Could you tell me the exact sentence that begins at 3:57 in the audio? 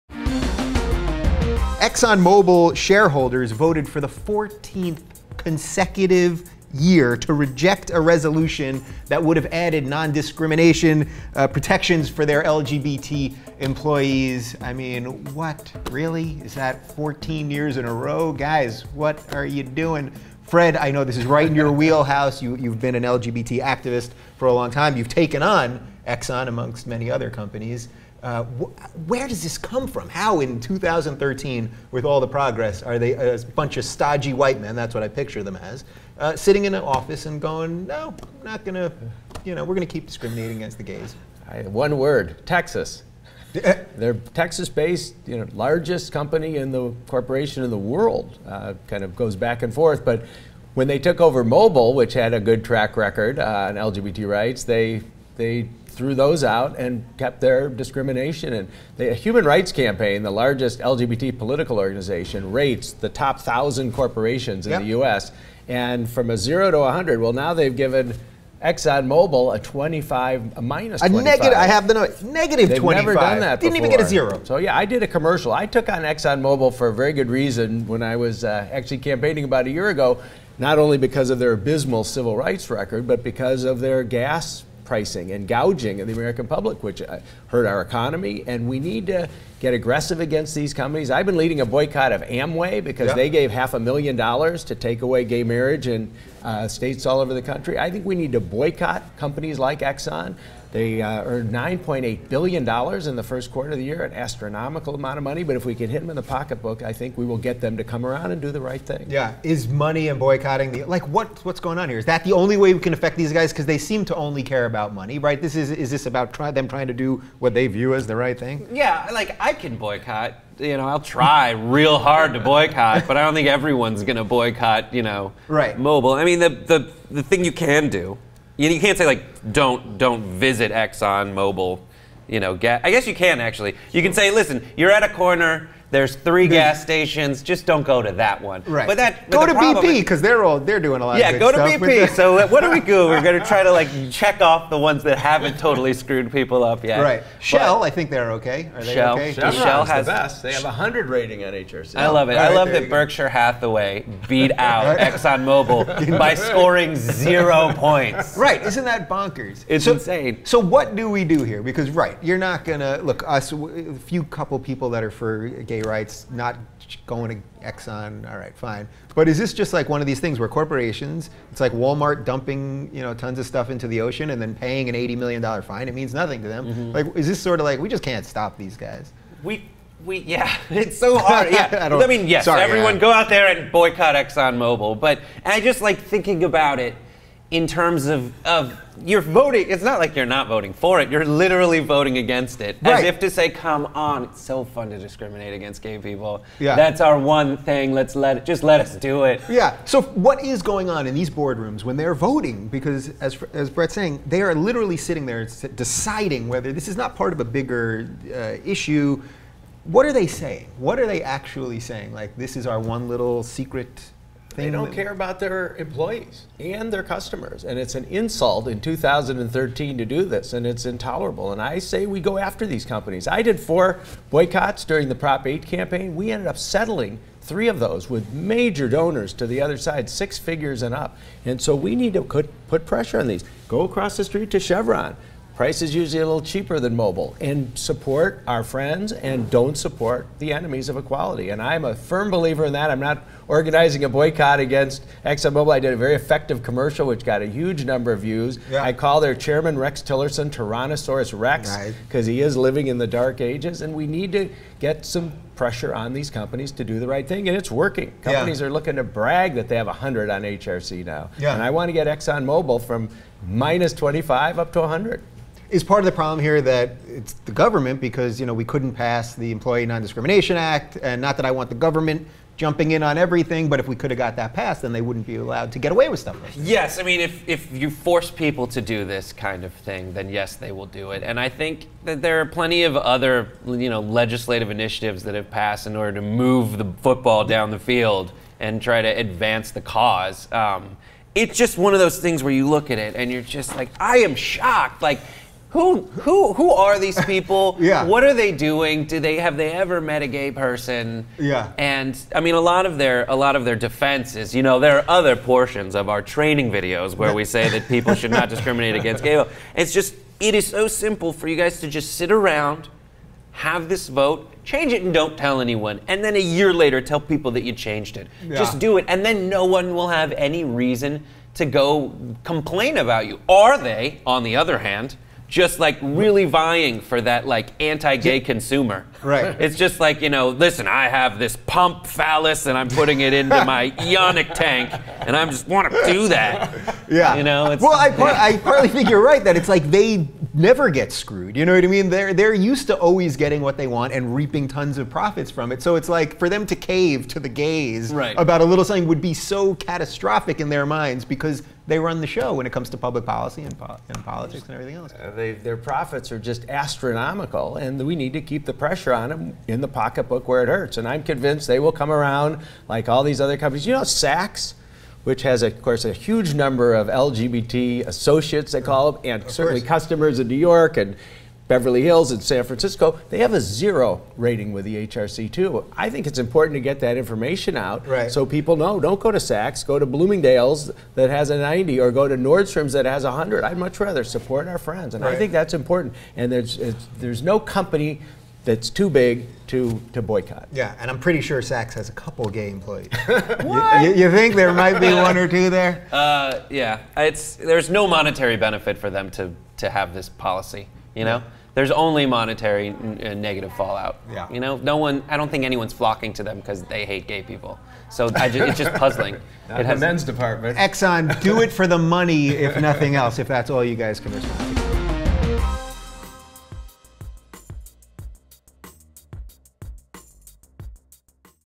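And support our friends and don't support the enemies of equality.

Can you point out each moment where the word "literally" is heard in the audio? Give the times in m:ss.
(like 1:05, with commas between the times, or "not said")
3:11, 3:24.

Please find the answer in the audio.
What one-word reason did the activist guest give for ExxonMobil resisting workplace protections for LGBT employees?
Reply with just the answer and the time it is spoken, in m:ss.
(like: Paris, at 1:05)
Texas, at 0:42.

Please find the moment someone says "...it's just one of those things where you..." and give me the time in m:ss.
4:51.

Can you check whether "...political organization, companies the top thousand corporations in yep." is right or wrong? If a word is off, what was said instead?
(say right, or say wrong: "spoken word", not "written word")
wrong: "rates", not "companies".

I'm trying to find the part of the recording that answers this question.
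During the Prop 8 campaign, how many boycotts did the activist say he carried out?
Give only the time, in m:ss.
3:43.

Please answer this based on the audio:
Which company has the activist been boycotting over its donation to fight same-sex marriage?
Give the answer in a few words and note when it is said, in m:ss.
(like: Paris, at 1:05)
Amway, at 1:32.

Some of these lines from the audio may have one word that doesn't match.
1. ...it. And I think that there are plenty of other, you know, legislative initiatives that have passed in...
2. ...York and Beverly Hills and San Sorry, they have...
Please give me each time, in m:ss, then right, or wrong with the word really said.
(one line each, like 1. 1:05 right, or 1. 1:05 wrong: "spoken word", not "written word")
1. 4:41 right
2. 6:10 wrong: "Francisco", not "Sorry".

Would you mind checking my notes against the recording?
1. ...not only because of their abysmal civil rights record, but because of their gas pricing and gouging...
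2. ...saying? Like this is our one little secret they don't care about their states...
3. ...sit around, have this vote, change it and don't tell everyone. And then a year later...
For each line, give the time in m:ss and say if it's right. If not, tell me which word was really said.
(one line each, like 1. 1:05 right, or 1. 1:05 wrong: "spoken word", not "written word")
1. 1:20 right
2. 3:31 wrong: "employees", not "states"
3. 5:12 wrong: "anyone", not "everyone".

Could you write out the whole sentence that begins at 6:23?
I'd much rather support our friends.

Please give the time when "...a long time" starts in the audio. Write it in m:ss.
0:24.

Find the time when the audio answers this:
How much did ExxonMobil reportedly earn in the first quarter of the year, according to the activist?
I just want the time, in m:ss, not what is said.
1:41.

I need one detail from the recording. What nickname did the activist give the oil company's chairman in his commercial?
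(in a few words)
Tyrannosaurus Rex.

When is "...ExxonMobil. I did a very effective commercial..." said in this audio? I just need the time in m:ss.
4:05.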